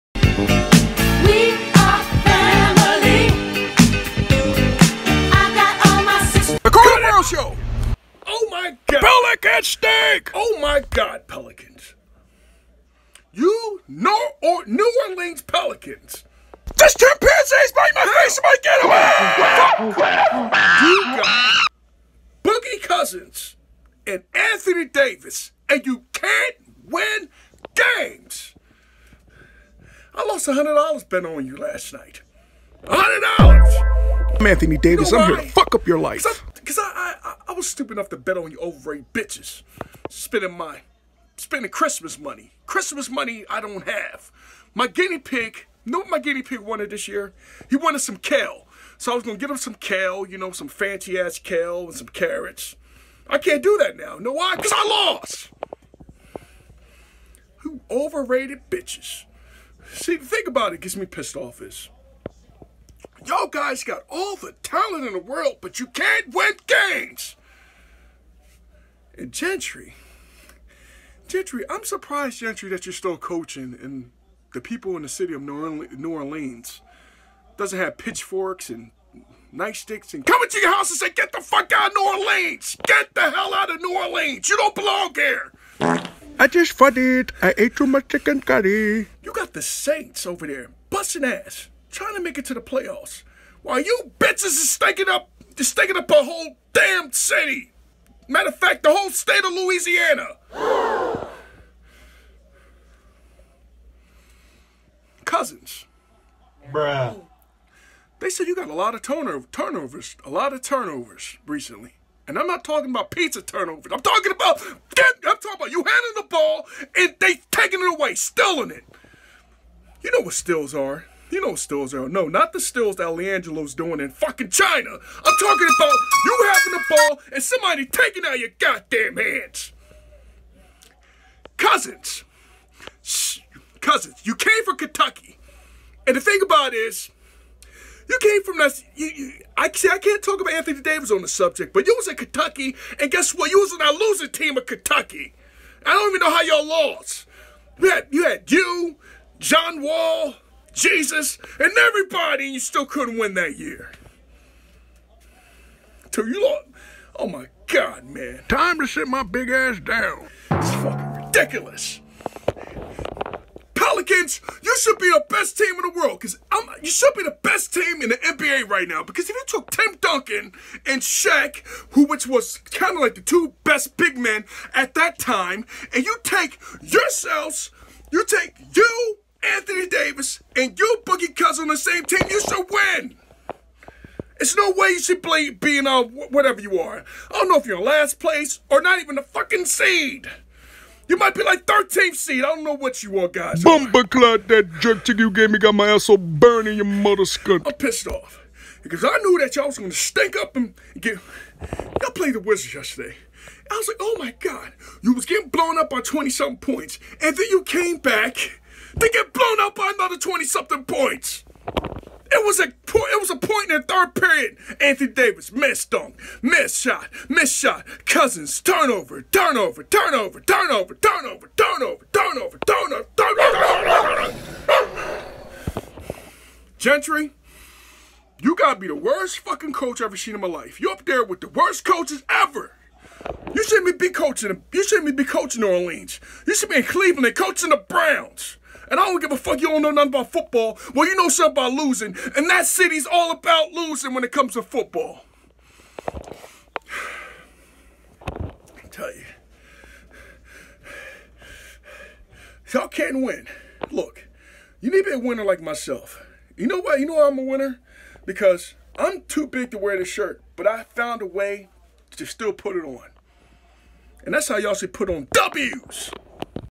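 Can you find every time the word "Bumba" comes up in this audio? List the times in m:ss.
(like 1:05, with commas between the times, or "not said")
3:13.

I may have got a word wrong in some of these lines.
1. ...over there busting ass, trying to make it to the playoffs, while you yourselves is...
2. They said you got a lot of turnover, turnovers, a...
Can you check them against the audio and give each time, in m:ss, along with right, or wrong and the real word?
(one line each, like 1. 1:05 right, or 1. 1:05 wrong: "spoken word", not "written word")
1. 1:30 wrong: "bitches", not "yourselves"
2. 1:48 right.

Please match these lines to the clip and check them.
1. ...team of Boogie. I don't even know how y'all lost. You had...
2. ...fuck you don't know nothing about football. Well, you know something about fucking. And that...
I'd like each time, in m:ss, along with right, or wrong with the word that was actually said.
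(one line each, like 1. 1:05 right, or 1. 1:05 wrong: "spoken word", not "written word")
1. 2:24 wrong: "Kentucky", not "Boogie"
2. 3:59 wrong: "losing", not "fucking".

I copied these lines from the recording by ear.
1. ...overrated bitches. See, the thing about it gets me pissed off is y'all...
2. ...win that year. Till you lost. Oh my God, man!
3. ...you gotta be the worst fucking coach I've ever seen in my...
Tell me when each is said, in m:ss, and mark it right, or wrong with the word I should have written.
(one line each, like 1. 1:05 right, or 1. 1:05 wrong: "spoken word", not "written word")
1. 0:57 right
2. 2:33 right
3. 3:48 right.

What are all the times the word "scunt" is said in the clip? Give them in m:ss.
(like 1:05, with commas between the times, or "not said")
3:17.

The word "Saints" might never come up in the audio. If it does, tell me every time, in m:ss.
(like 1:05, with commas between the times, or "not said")
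1:29.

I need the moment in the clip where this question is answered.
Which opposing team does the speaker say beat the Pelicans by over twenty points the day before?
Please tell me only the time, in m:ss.
3:22.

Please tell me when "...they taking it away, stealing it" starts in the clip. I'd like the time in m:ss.
1:57.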